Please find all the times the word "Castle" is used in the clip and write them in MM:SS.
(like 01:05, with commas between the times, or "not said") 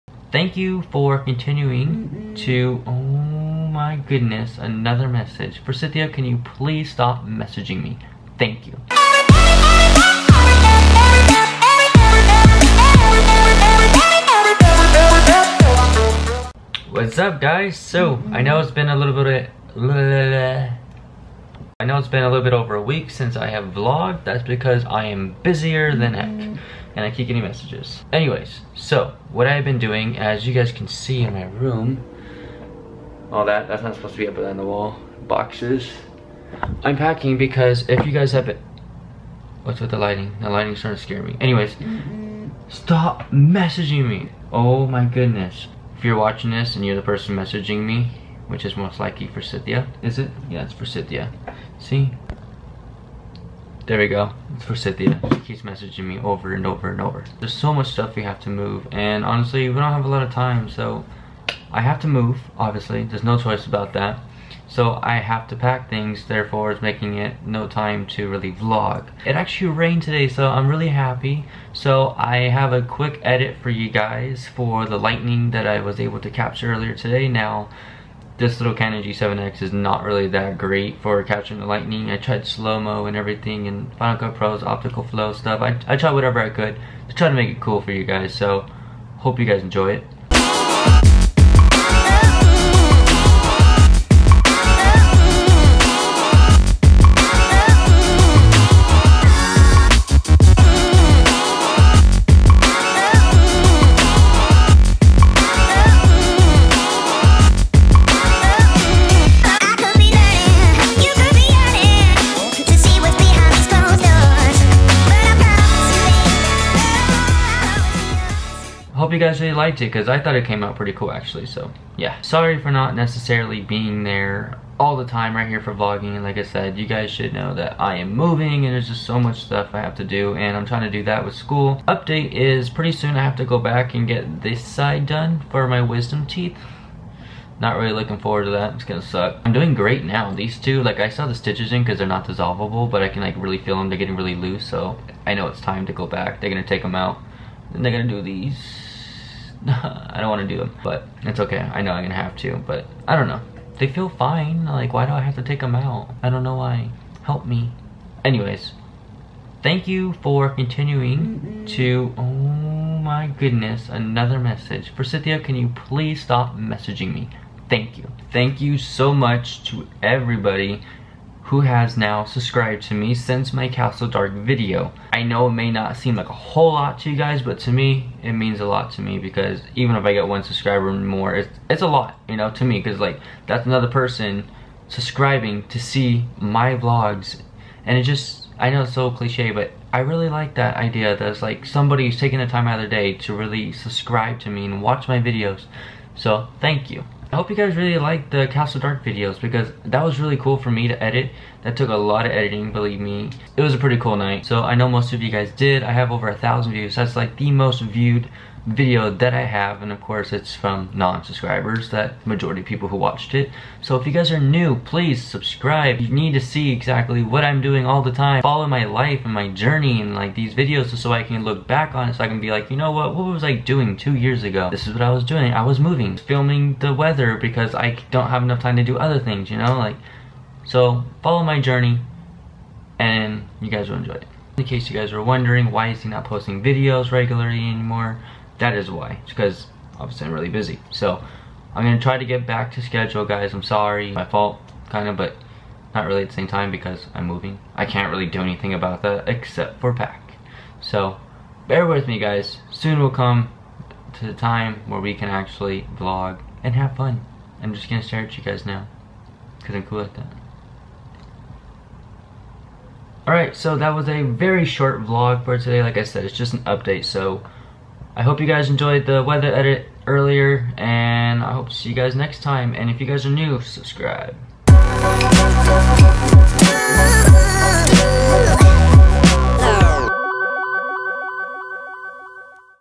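02:53, 03:18.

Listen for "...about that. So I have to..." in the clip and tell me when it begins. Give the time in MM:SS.
01:03.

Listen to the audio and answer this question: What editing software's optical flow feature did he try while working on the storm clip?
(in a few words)
Final Cut Pro.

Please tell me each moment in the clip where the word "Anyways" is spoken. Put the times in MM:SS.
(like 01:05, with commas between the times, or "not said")
00:28, 00:41, 02:38.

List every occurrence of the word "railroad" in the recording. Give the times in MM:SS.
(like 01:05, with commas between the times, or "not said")
not said.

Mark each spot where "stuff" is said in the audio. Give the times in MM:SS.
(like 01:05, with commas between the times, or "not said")
00:57, 01:25, 02:09.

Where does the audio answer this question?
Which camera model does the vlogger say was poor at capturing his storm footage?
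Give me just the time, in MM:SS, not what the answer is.
01:18.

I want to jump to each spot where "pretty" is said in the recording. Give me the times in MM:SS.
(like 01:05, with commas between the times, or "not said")
02:00, 02:12, 03:23.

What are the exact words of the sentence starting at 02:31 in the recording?
I know I'm gonna have to, but I don't know.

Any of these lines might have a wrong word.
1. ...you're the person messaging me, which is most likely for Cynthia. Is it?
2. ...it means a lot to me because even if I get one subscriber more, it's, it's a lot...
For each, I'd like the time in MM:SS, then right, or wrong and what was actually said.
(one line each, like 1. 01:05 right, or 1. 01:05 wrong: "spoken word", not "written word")
1. 00:46 right
2. 02:58 right.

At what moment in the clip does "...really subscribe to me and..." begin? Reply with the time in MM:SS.
03:13.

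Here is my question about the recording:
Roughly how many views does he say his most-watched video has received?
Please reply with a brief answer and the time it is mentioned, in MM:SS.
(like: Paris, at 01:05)
over 1,000, at 03:26.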